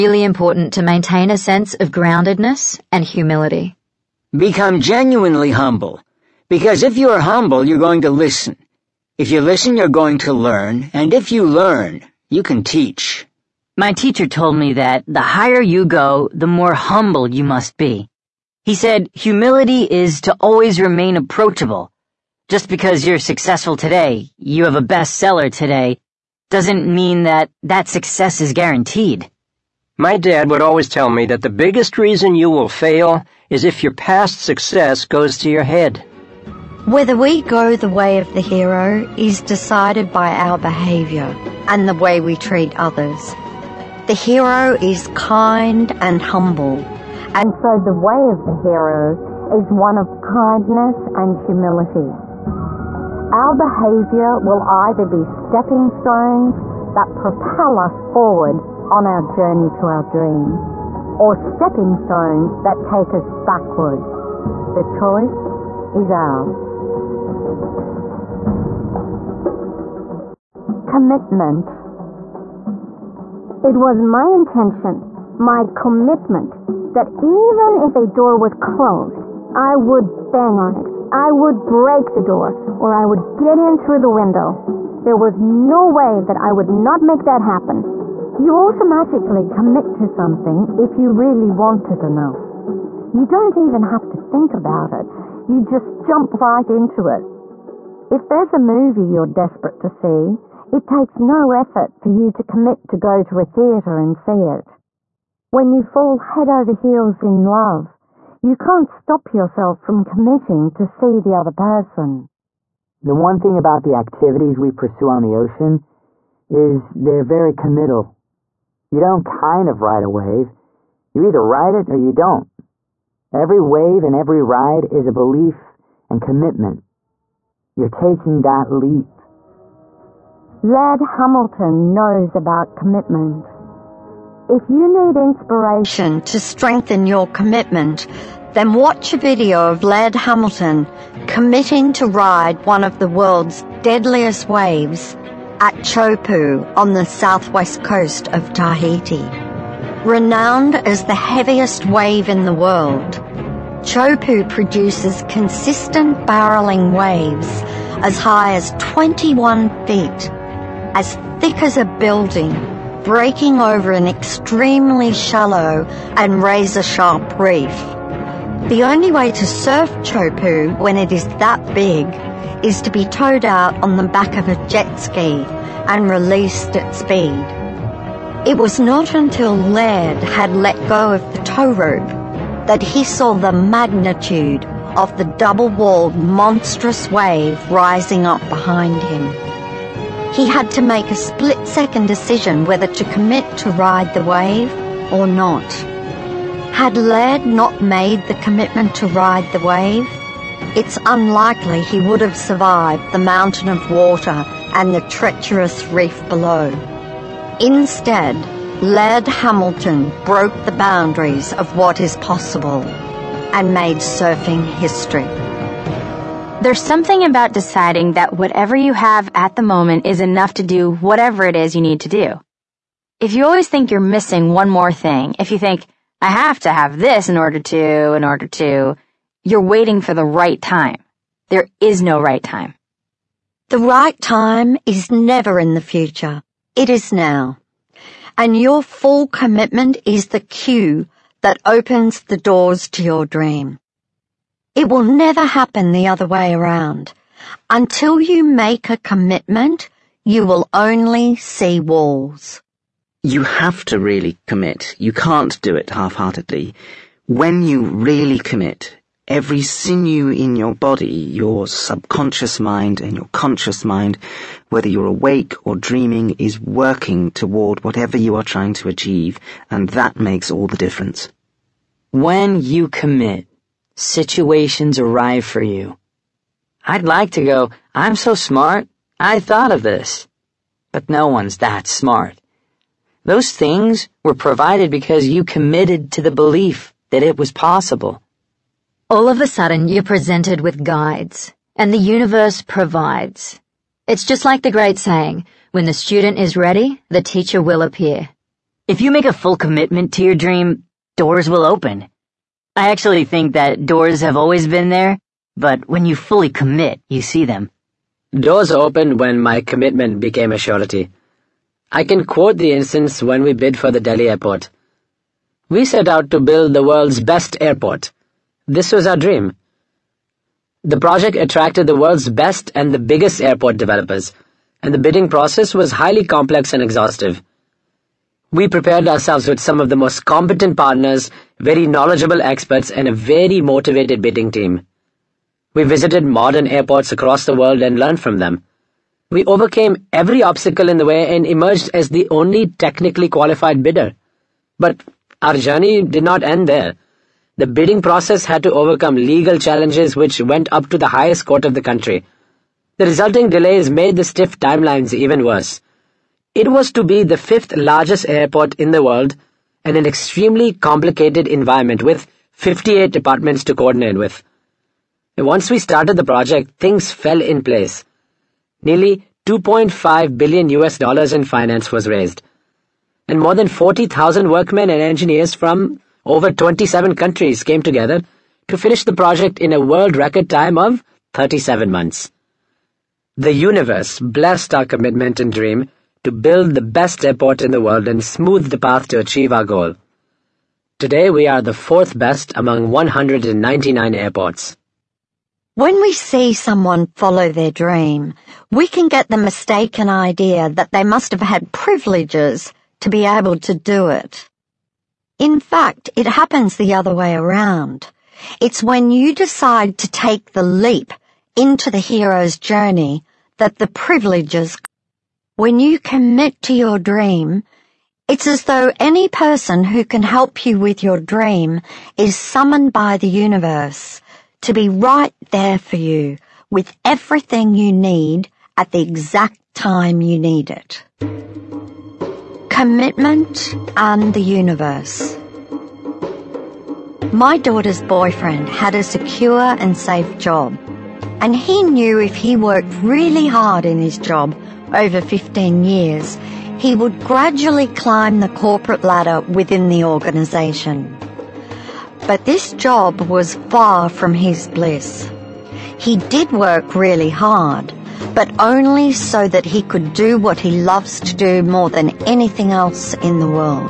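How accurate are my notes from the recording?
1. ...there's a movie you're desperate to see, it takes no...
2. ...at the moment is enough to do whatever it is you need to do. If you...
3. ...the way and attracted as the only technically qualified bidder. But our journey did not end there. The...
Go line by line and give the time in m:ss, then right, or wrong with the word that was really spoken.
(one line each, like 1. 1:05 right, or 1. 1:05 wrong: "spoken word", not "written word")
1. 1:38 right
2. 3:39 right
3. 5:40 wrong: "emerged", not "attracted".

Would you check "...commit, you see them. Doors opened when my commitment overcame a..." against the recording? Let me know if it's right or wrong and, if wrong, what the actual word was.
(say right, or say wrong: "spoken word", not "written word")
wrong: "became", not "overcame".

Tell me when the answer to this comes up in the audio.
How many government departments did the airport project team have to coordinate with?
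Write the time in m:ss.
6:02.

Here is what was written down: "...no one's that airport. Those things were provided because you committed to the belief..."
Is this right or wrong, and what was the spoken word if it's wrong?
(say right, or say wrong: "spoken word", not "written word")
wrong: "smart", not "airport".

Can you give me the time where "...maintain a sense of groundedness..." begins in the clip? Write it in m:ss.
0:00.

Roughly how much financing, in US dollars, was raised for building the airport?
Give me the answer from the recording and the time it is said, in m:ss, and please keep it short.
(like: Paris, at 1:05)
2.5 billion US dollars, at 6:09.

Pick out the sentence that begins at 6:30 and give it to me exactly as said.
Today we are the fourth best among 199 airports.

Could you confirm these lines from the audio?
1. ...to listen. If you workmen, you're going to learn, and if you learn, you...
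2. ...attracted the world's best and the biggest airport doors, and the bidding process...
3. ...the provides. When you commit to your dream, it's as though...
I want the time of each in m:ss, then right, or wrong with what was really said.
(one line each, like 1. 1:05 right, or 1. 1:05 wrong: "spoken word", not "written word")
1. 0:08 wrong: "listen", not "workmen"
2. 5:21 wrong: "developers", not "doors"
3. 6:53 wrong: "privileges", not "provides".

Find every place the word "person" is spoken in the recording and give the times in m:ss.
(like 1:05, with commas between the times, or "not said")
1:51, 6:59.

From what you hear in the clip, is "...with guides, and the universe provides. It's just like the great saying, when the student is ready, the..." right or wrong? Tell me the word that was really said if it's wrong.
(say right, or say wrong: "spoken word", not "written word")
right.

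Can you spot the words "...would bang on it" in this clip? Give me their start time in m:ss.
1:19.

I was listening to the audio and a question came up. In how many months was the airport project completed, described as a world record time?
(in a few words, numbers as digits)
37.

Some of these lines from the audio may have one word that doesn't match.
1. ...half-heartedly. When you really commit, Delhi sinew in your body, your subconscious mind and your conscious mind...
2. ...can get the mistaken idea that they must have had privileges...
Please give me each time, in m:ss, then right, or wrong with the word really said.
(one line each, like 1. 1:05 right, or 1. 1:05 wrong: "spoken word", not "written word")
1. 4:15 wrong: "Every", not "Delhi"
2. 6:38 right.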